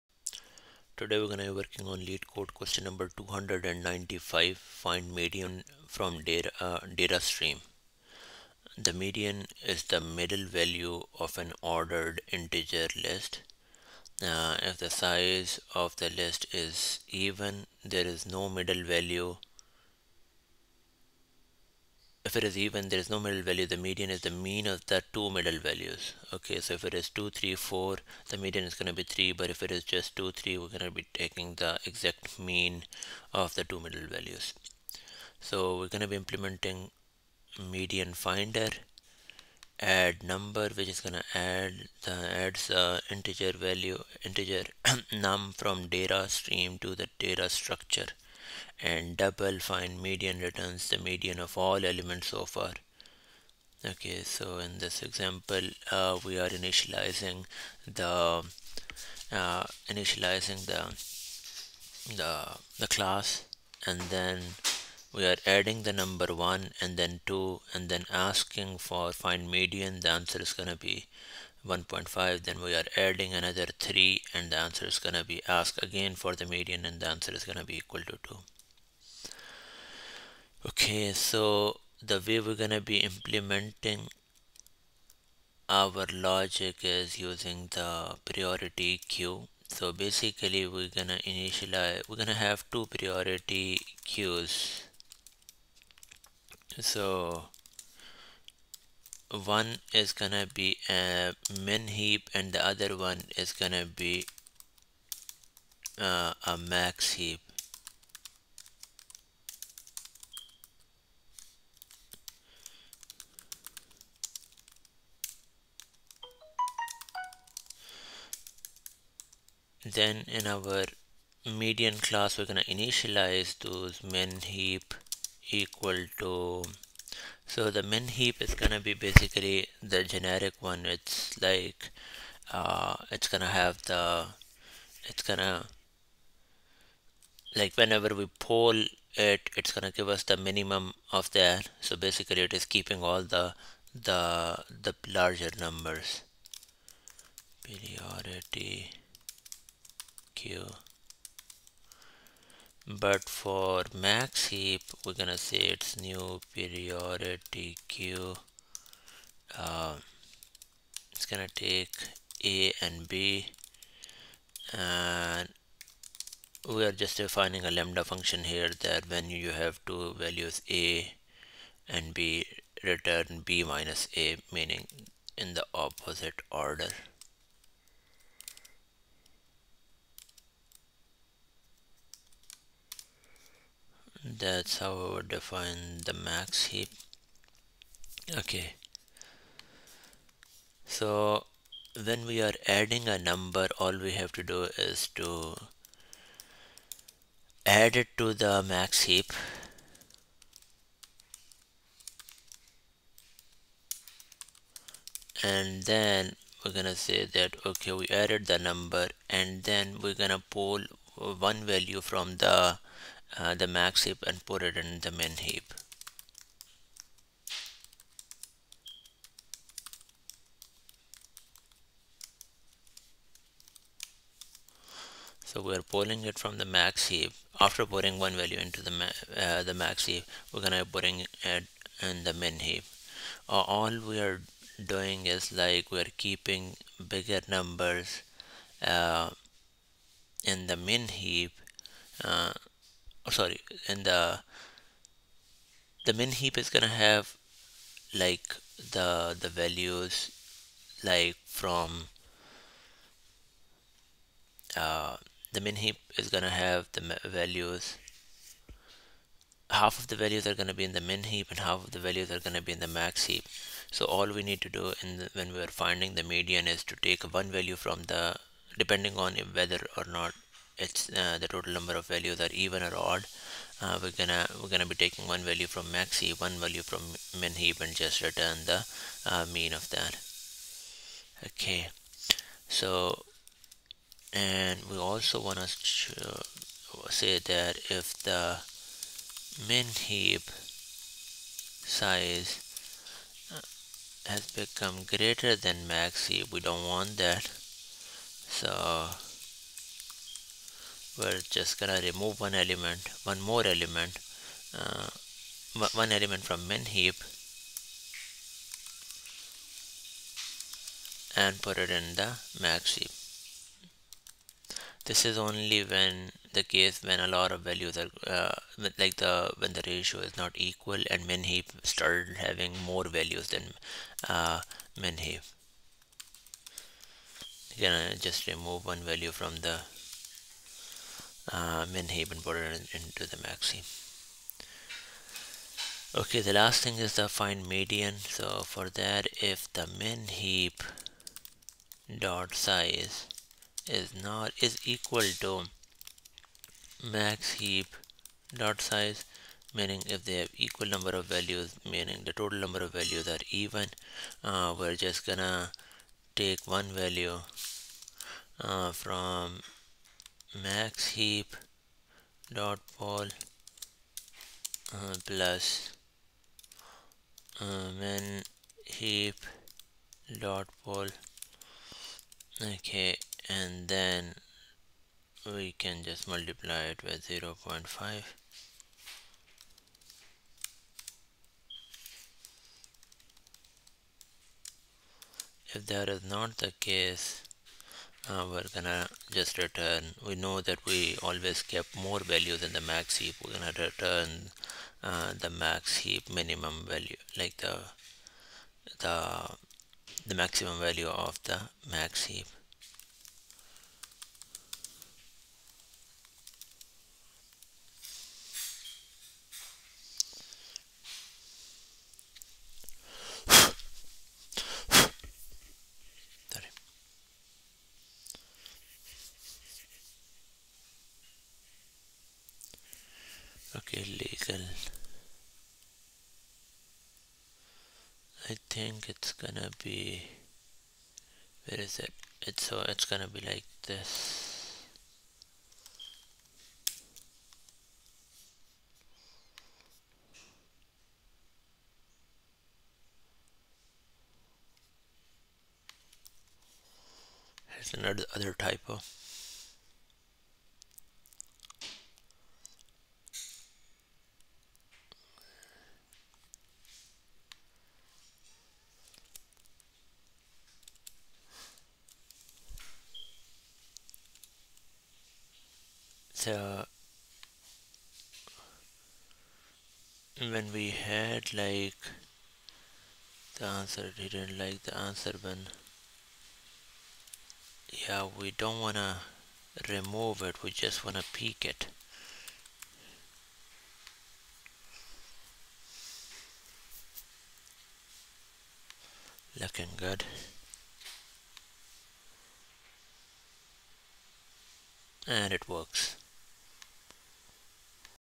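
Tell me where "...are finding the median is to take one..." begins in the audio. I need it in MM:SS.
04:25.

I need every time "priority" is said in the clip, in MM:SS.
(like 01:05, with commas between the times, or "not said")
01:28, 01:32, 02:27, 02:36.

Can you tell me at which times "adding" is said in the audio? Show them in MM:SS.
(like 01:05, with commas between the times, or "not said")
01:05, 01:12, 03:12.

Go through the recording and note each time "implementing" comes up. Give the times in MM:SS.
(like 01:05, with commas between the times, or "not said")
00:36, 01:22.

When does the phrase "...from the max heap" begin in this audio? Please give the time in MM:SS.
03:46.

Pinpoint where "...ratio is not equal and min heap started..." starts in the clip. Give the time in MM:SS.
05:19.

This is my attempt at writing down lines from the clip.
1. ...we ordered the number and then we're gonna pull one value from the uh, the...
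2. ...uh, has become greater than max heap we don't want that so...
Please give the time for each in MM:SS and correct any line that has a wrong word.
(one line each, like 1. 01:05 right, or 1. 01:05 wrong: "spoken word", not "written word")
1. 03:27 wrong: "added", not "ordered"
2. 04:53 right.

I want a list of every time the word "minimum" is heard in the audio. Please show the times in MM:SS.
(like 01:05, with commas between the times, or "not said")
02:20, 06:36.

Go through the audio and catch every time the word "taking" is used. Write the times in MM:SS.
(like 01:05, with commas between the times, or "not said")
00:31, 04:35.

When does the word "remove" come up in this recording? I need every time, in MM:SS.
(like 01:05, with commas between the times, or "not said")
05:02, 05:28, 07:59.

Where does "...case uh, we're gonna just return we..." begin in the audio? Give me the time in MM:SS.
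06:26.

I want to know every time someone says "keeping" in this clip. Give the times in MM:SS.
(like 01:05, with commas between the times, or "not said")
02:22, 03:56.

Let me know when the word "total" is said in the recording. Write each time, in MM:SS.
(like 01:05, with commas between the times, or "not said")
04:31, 05:52.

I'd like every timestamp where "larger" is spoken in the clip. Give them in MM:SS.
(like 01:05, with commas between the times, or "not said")
02:25.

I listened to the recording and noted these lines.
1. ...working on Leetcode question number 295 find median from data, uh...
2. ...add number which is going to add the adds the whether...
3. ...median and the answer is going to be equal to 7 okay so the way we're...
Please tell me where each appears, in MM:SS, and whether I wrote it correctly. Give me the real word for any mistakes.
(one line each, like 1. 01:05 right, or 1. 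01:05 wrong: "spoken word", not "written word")
1. 00:01 right
2. 00:39 wrong: "integer", not "whether"
3. 01:16 wrong: "2", not "7".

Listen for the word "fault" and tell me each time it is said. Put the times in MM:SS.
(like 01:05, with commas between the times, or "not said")
not said.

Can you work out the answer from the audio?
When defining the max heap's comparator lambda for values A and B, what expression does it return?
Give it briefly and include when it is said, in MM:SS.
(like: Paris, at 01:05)
B minus A, at 02:53.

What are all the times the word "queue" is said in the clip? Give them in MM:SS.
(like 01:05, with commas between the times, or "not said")
01:28, 01:34, 02:37.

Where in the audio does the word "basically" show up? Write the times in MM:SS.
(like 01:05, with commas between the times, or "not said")
01:29, 02:08, 02:21.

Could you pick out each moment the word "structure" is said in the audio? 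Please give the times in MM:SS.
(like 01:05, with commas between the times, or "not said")
00:47.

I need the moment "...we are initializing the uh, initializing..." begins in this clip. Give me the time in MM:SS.
00:56.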